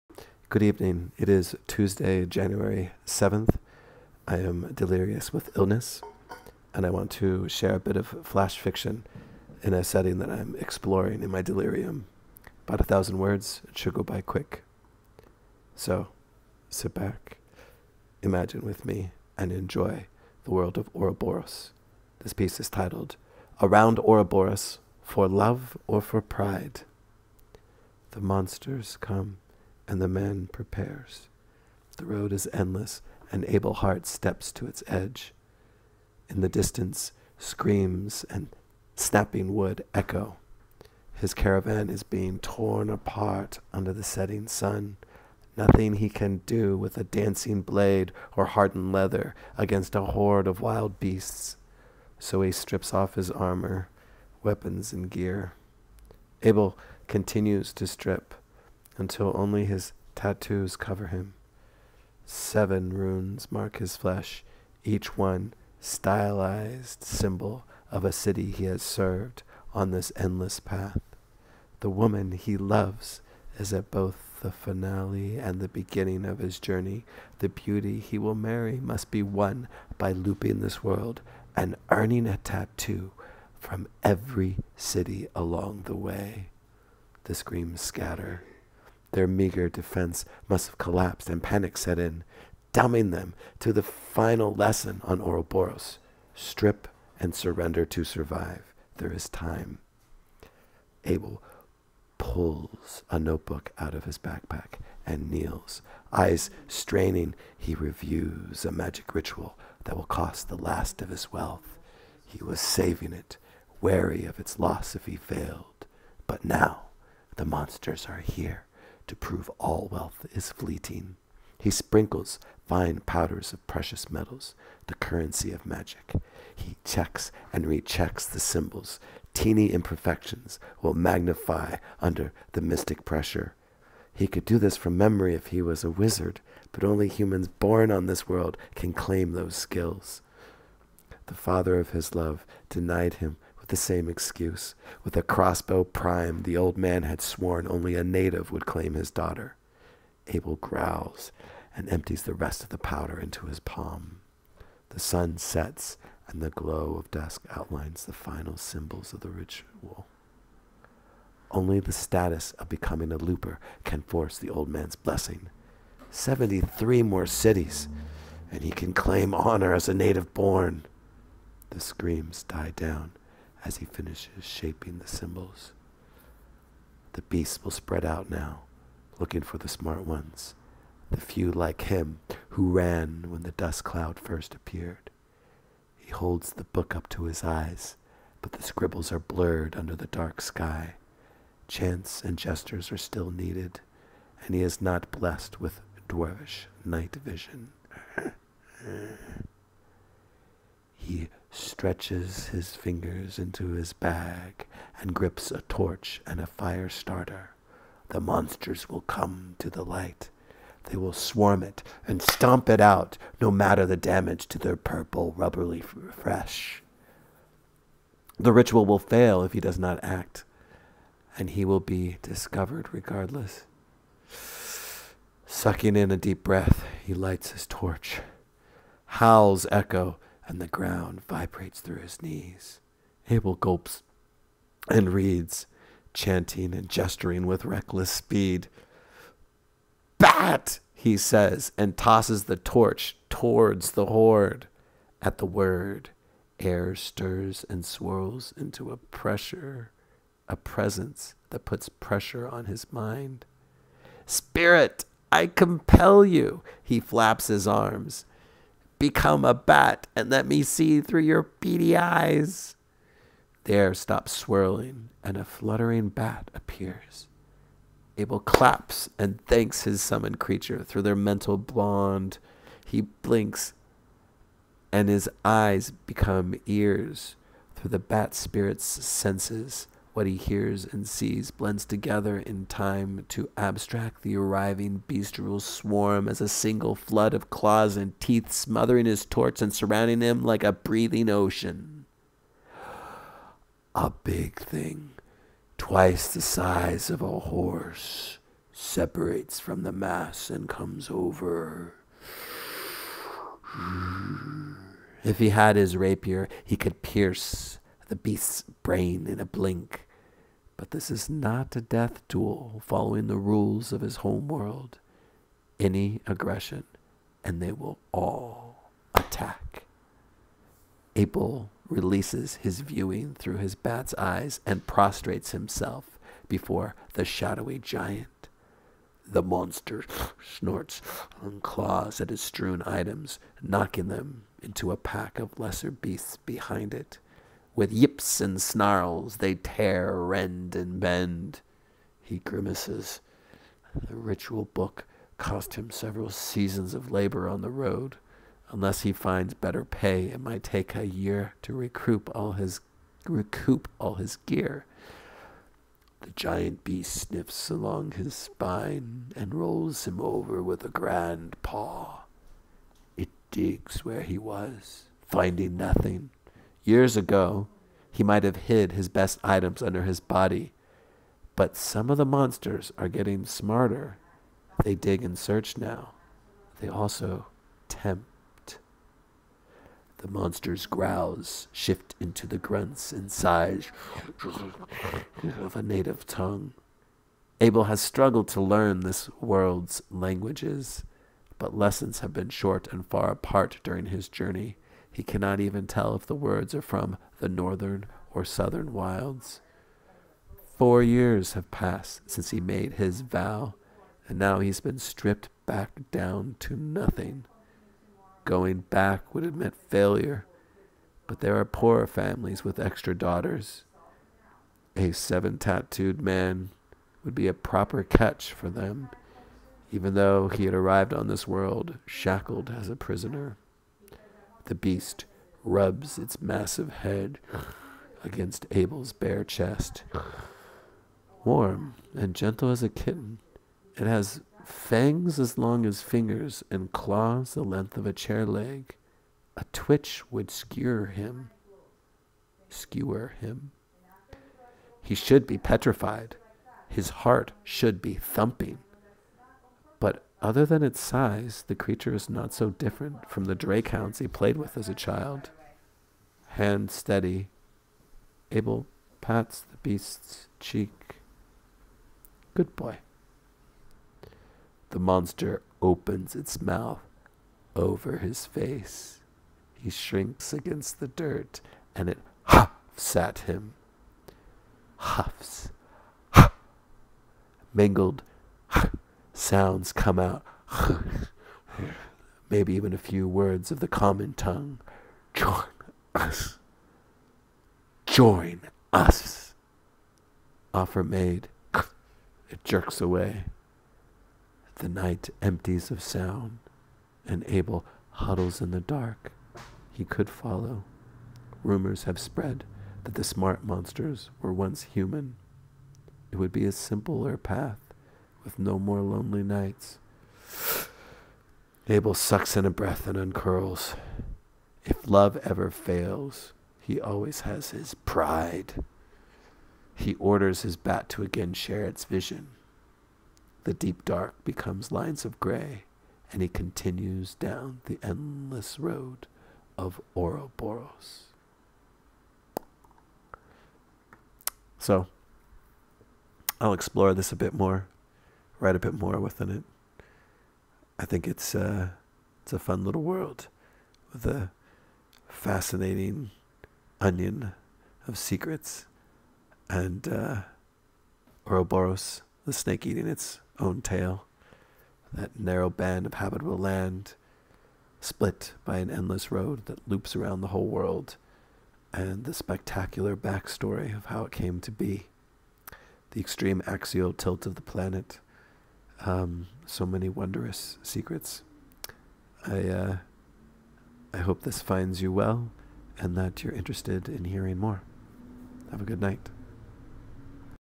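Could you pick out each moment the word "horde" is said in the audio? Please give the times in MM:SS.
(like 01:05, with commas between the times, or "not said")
00:50, 04:04.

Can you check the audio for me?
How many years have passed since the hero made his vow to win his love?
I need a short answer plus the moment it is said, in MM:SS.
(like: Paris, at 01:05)
4, at 06:40.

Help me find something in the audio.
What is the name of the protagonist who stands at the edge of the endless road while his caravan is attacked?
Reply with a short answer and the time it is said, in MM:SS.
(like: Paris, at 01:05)
Abel Hart, at 00:33.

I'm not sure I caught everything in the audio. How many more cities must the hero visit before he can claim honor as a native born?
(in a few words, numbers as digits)
73.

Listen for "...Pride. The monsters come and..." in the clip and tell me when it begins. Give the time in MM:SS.
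00:26.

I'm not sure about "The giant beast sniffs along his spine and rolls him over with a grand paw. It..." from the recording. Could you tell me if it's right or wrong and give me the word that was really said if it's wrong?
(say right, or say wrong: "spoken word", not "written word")
right.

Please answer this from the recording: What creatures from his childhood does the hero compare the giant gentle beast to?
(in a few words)
drakehounds.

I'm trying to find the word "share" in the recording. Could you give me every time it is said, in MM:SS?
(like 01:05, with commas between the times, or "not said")
00:07, 08:41.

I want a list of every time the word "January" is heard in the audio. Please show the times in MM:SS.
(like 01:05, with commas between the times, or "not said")
00:02.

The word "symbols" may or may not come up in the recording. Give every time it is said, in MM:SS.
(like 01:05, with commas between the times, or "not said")
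01:07, 02:08, 02:38, 02:55.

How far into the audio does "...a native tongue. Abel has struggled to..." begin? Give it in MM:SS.
06:25.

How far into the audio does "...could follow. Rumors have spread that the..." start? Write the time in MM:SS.
08:20.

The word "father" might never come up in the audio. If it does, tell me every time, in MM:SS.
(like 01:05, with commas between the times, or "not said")
02:21.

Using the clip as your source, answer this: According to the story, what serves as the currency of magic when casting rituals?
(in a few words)
precious metals.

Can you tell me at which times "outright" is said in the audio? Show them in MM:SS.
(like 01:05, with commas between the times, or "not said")
not said.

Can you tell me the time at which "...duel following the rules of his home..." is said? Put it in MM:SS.
05:12.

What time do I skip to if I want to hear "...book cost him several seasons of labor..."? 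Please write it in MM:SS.
05:44.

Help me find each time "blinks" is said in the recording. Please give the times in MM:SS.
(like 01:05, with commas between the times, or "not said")
04:33, 05:09.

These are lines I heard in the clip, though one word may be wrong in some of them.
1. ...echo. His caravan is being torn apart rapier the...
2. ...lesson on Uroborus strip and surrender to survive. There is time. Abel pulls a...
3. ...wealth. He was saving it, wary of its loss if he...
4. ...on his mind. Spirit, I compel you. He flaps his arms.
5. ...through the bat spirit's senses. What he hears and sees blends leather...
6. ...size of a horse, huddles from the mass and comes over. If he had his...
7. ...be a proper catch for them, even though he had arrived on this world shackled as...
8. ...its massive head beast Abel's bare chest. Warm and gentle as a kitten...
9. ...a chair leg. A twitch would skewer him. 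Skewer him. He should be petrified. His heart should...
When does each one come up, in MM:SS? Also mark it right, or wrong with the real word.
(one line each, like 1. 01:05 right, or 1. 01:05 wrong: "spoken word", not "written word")
1. 00:39 wrong: "under", not "rapier"
2. 01:34 right
3. 01:51 right
4. 04:12 right
5. 04:37 wrong: "together", not "leather"
6. 04:56 wrong: "separates", not "huddles"
7. 06:57 right
8. 07:06 wrong: "against", not "beast"
9. 07:18 right.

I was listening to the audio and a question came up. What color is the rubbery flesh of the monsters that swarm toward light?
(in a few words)
purple.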